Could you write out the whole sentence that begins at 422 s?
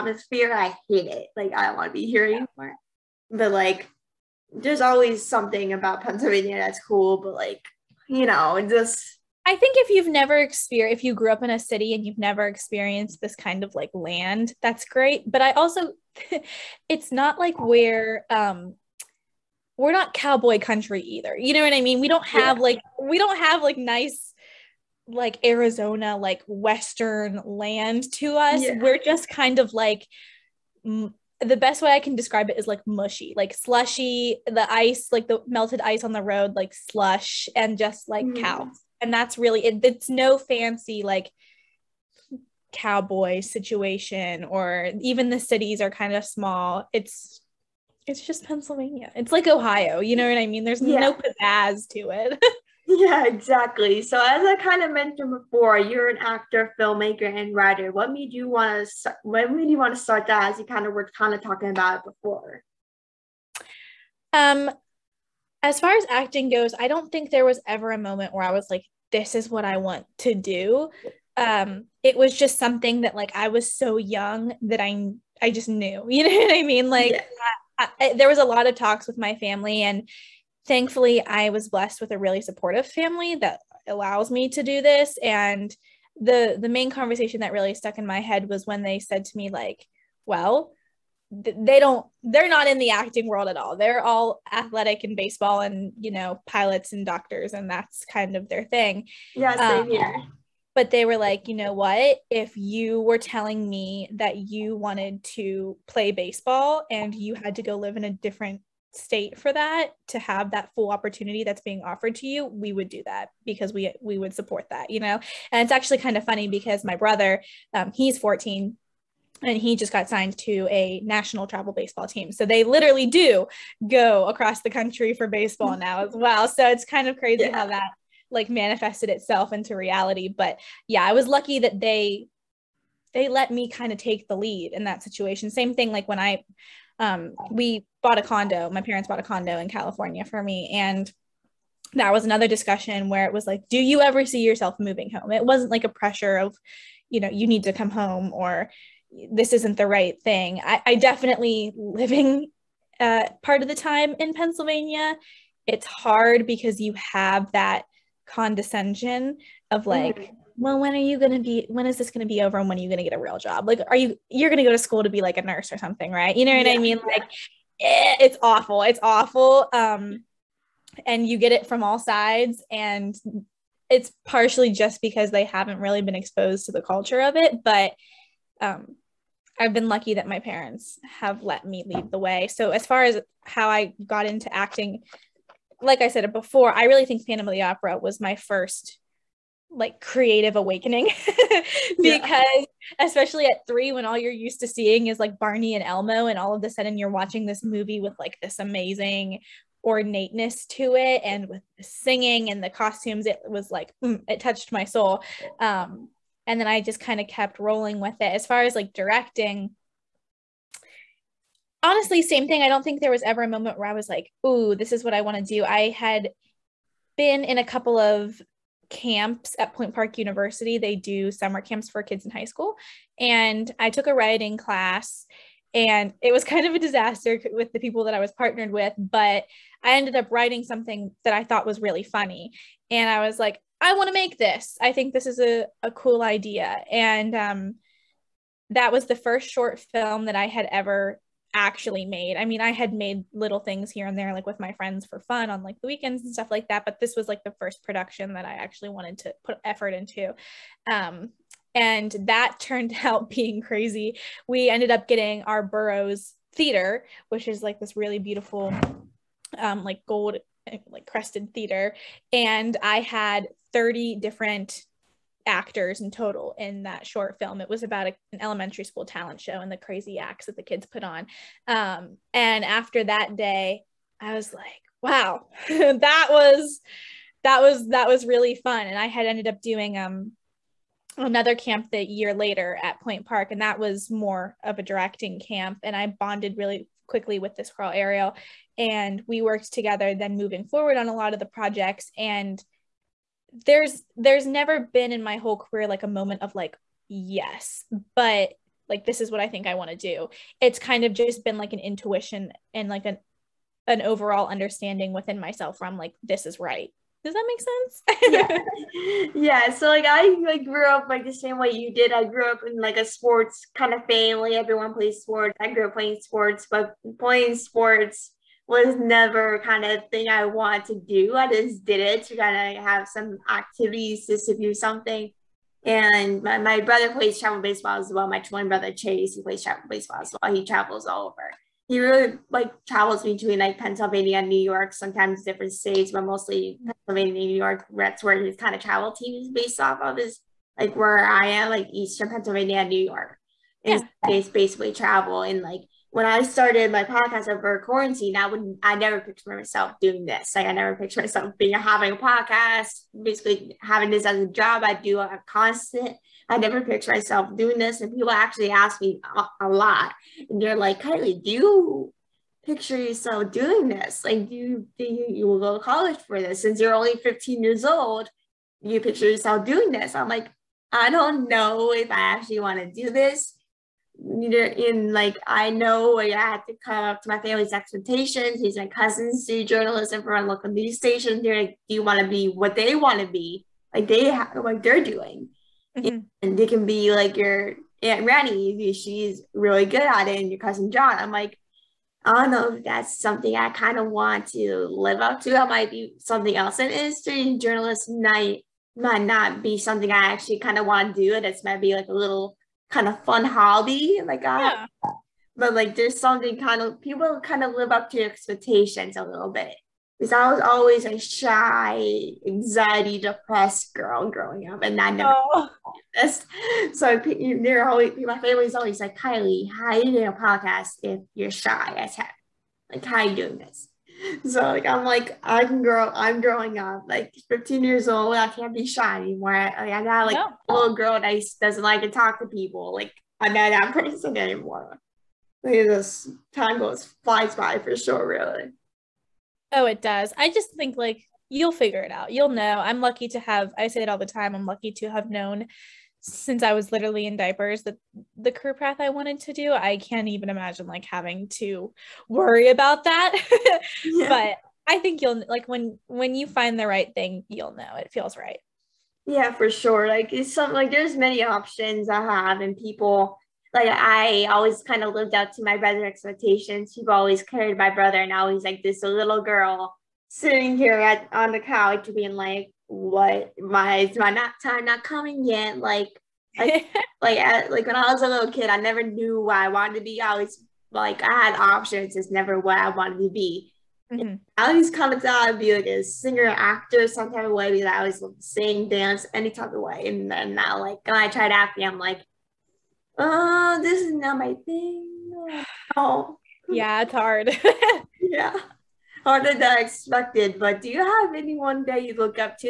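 Like, how are you doing this?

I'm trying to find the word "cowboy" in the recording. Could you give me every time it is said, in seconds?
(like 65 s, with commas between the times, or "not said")
20 s, 42 s.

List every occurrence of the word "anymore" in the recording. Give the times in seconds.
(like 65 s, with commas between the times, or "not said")
2 s, 429 s, 434 s.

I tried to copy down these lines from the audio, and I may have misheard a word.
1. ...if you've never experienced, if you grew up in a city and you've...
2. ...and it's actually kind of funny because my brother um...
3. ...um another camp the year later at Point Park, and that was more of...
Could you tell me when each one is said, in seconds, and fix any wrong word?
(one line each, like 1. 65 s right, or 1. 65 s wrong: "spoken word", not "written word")
1. 9 s right
2. 115 s right
3. 279 s right.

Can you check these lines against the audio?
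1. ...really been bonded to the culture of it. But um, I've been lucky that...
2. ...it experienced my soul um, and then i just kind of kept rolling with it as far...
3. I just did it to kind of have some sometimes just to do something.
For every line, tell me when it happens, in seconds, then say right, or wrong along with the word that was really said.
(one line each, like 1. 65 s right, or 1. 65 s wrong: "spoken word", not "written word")
1. 175 s wrong: "exposed", not "bonded"
2. 204 s wrong: "touched", not "experienced"
3. 321 s wrong: "activities", not "sometimes".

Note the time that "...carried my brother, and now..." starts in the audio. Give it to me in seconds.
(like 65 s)
467 s.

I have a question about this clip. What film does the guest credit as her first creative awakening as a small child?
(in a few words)
Phantom of the Opera.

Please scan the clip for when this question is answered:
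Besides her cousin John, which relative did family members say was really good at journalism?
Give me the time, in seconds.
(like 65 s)
388 s.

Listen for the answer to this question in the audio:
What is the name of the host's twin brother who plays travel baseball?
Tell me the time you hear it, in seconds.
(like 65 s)
328 s.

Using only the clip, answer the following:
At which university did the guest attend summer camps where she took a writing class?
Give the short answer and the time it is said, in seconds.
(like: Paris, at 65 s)
Point Park University, at 219 s.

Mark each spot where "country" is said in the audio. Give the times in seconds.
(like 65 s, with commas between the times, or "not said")
20 s, 124 s.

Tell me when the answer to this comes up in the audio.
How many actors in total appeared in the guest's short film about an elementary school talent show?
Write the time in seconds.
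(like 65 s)
263 s.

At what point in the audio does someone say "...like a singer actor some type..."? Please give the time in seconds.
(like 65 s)
485 s.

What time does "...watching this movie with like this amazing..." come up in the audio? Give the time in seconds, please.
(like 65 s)
197 s.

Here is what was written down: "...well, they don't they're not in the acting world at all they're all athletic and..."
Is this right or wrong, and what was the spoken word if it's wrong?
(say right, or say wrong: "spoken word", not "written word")
right.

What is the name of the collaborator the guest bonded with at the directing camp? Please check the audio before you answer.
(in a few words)
Ariel.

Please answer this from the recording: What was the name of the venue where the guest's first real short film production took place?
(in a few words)
Burroughs Theater.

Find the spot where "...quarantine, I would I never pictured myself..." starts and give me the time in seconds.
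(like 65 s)
347 s.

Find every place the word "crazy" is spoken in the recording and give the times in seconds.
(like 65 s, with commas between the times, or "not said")
127 s, 253 s, 269 s.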